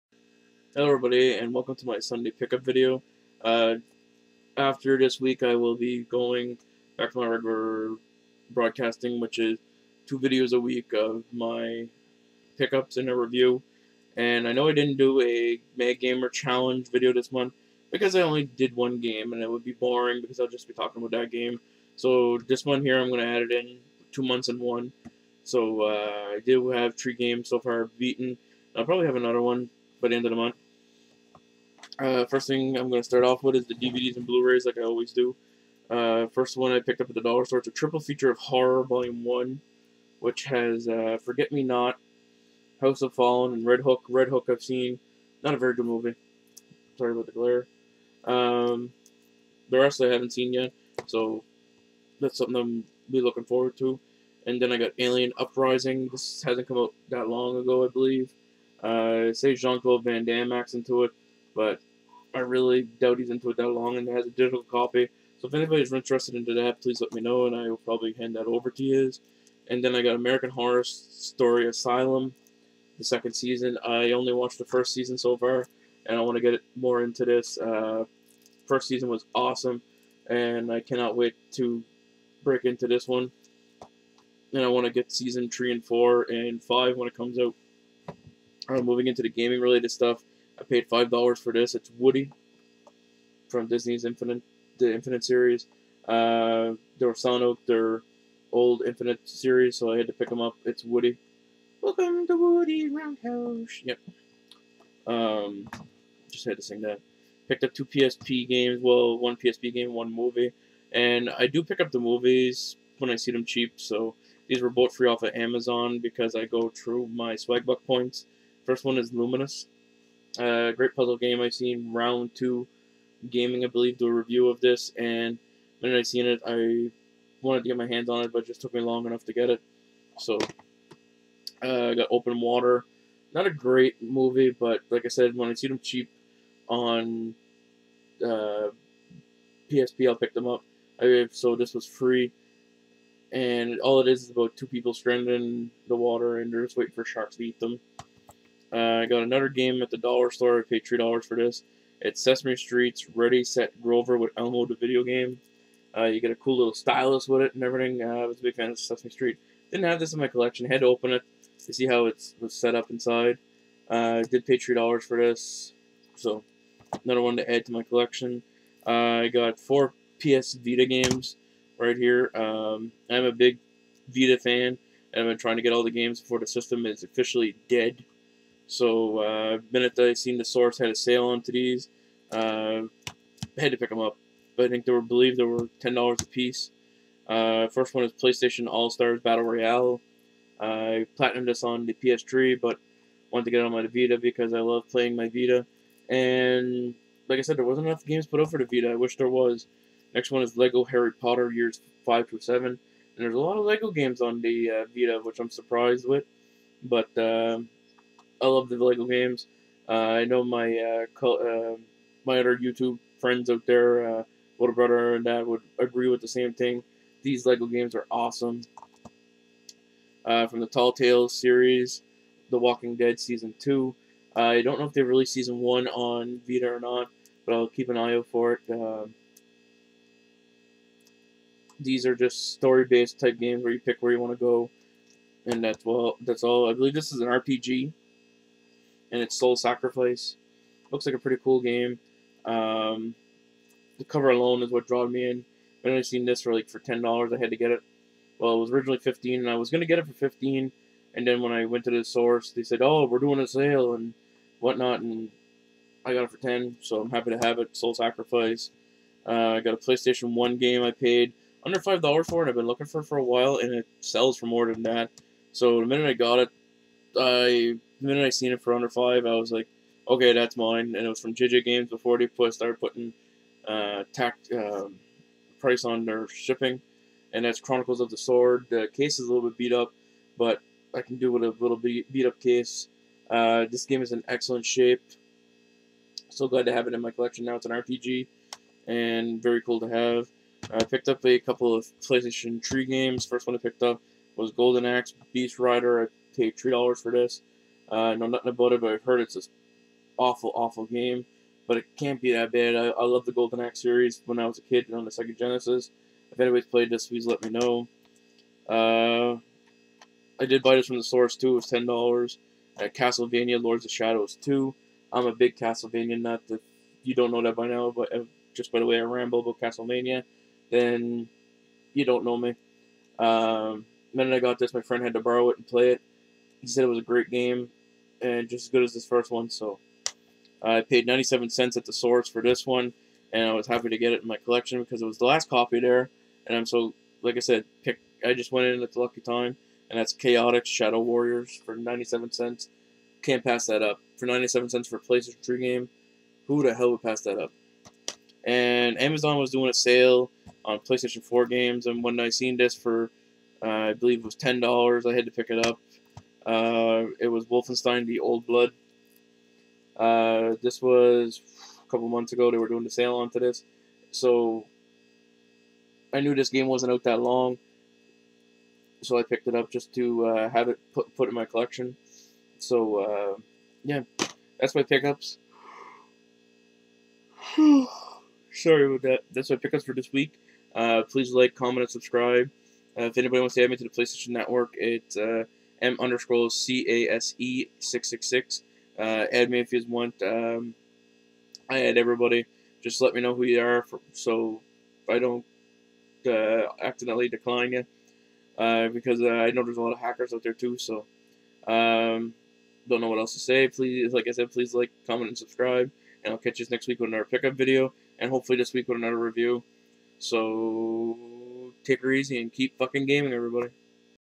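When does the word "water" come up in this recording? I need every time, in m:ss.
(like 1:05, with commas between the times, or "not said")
2:12, 2:25.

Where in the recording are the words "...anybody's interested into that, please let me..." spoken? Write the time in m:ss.
1:05.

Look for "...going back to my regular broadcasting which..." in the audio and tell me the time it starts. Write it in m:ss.
0:06.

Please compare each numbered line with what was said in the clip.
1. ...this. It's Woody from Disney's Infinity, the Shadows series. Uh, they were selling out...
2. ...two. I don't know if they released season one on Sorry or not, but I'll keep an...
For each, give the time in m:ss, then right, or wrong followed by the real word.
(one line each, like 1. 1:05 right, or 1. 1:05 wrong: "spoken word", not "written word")
1. 1:31 wrong: "Infinity", not "Shadows"
2. 3:43 wrong: "Vita", not "Sorry".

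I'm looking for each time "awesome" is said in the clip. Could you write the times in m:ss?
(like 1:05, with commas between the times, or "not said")
1:19, 3:38.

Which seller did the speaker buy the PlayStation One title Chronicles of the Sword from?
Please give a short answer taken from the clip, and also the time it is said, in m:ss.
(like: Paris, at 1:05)
JJ Games, at 4:31.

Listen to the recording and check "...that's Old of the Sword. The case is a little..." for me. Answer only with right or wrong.
wrong.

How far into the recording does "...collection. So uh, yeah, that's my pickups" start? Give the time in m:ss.
6:11.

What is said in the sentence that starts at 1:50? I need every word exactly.
And I do pick up the movies when I see them cheap.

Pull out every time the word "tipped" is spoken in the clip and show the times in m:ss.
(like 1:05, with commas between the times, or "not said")
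not said.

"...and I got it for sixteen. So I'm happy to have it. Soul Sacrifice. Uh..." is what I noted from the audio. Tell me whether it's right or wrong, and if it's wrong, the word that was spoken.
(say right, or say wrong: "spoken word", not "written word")
wrong: "ten", not "sixteen".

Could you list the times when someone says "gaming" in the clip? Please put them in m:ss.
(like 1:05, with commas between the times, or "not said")
1:29, 2:03, 6:53.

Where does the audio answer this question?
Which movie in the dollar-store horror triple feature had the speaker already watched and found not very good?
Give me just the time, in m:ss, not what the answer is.
0:44.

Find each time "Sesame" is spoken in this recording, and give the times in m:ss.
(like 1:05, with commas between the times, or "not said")
2:32, 2:38.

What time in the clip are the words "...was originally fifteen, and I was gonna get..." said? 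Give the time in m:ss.
4:08.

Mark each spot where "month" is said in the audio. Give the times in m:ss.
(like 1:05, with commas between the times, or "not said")
0:17, 0:24, 0:30, 6:02.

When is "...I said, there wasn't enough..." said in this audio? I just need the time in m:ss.
3:17.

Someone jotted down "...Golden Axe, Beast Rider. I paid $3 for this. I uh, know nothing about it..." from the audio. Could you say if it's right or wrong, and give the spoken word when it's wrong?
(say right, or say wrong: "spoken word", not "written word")
right.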